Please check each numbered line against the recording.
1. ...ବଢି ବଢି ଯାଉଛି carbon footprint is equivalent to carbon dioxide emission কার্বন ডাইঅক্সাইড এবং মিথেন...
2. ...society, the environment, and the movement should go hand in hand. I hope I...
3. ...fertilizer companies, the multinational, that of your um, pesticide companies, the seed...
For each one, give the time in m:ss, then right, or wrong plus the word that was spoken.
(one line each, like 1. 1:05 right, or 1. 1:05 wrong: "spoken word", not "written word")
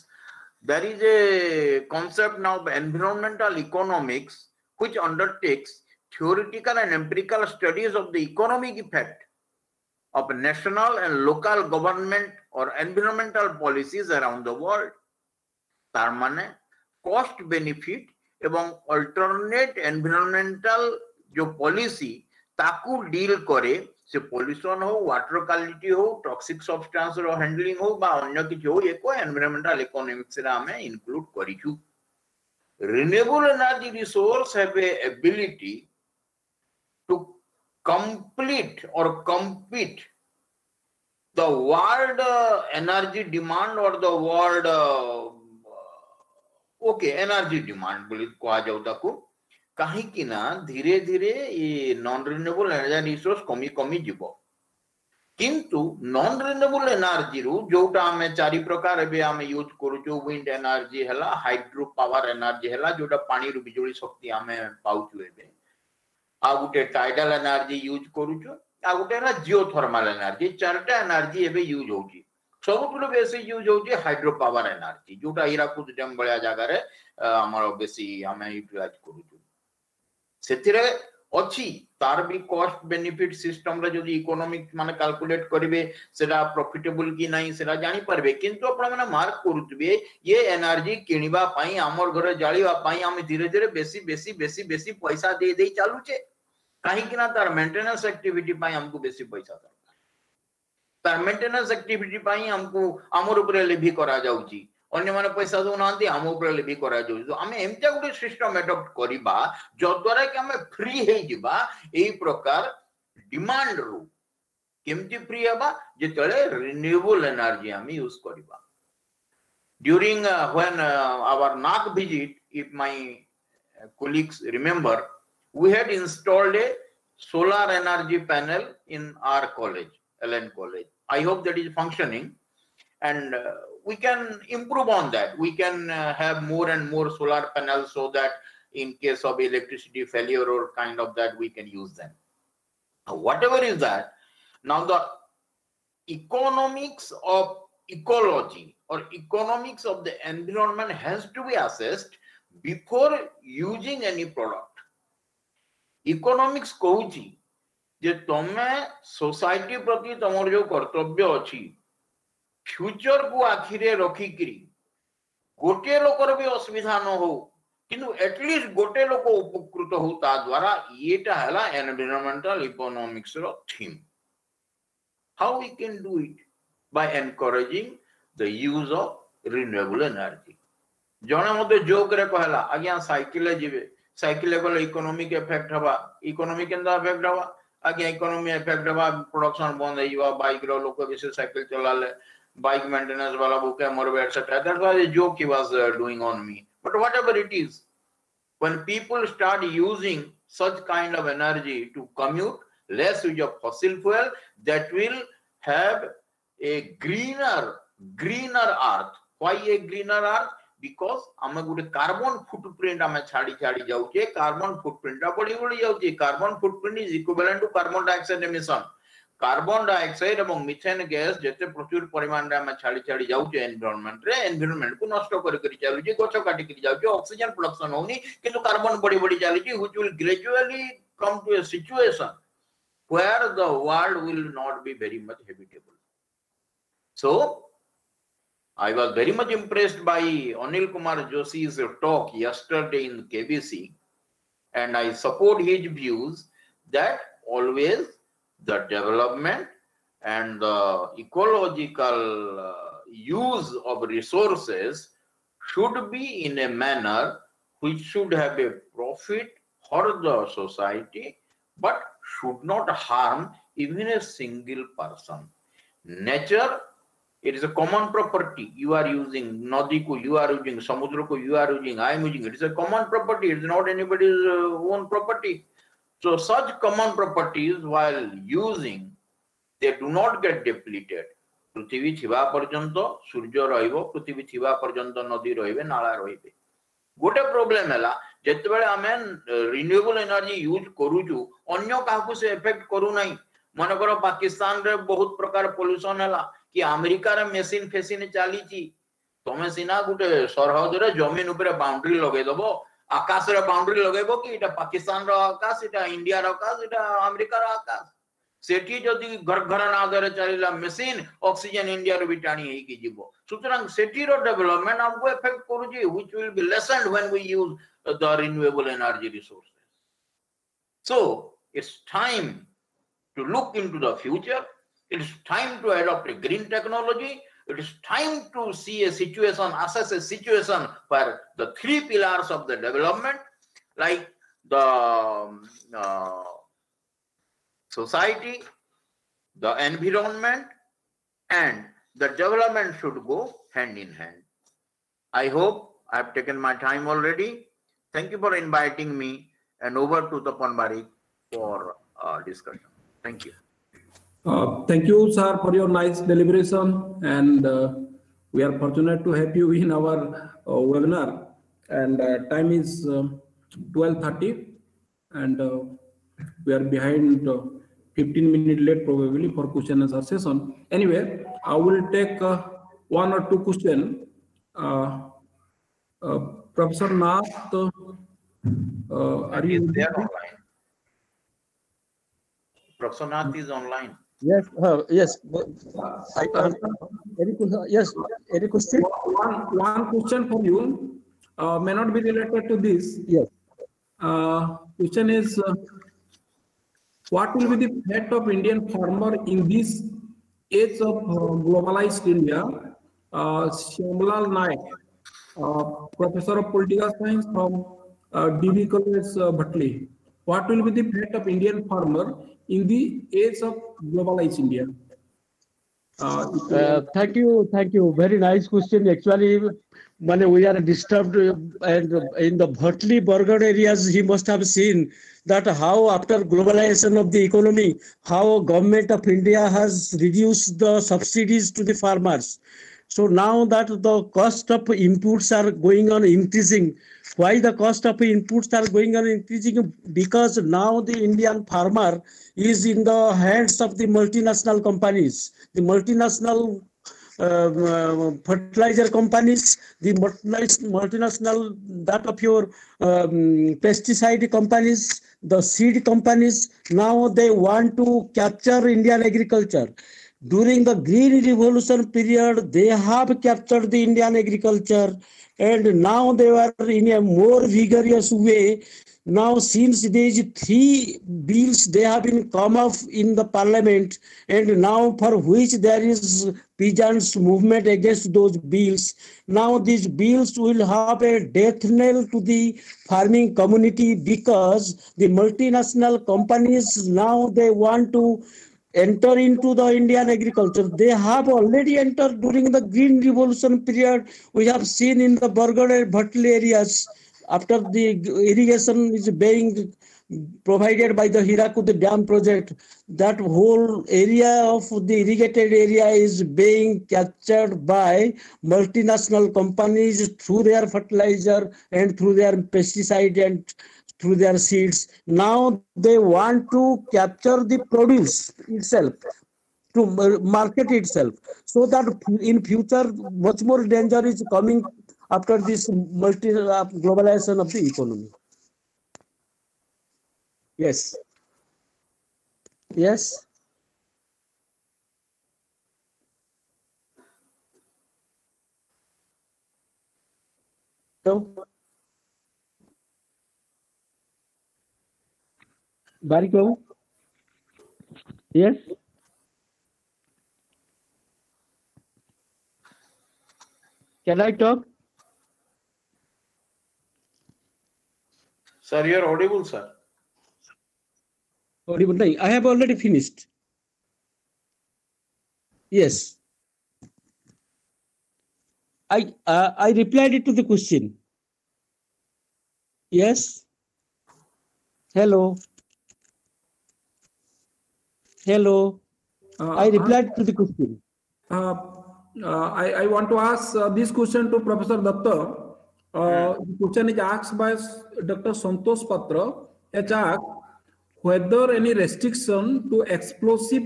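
1. 3:35 right
2. 5:37 wrong: "development", not "movement"
3. 7:28 right.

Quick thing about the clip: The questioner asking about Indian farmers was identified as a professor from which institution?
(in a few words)
DB College, Bhatli.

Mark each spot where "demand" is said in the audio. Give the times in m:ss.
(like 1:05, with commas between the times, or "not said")
0:43, 0:47.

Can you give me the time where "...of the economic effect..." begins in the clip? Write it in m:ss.
0:07.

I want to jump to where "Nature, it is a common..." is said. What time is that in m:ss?
4:26.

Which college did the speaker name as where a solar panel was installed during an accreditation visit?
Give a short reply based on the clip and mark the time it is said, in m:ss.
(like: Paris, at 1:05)
LN College, at 2:10.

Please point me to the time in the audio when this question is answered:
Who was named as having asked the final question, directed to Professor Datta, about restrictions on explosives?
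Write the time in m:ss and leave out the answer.
9:48.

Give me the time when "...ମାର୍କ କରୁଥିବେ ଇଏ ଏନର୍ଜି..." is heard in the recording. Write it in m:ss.
1:29.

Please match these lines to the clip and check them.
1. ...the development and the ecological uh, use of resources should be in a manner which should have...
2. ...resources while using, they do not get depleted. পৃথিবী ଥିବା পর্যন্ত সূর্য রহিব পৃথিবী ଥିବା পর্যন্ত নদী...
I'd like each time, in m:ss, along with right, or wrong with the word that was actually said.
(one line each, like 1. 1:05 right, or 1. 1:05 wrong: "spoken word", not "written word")
1. 4:08 right
2. 4:37 wrong: "properties", not "resources".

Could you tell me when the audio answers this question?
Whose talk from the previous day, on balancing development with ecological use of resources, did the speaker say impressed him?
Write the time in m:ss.
4:00.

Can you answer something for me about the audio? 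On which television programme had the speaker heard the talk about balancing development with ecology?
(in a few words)
KBC.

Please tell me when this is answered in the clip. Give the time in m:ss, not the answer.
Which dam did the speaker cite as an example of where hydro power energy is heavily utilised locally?
1:15.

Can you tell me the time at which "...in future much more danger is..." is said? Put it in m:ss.
8:42.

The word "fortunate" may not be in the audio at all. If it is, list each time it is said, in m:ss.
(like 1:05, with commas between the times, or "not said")
5:58.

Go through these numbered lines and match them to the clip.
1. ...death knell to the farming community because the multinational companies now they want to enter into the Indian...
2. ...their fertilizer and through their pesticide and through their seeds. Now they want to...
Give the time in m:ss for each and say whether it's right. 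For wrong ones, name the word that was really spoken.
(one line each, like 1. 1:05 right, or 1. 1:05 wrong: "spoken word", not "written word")
1. 8:01 right
2. 8:30 right.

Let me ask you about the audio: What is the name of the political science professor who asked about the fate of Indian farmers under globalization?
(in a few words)
Shyamlal Naik.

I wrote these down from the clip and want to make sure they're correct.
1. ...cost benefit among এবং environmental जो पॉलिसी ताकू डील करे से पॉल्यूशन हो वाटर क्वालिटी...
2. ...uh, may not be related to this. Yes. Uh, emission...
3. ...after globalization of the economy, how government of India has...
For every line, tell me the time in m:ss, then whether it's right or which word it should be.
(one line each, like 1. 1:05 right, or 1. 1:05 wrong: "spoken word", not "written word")
1. 0:17 right
2. 6:31 wrong: "question", not "emission"
3. 7:06 right.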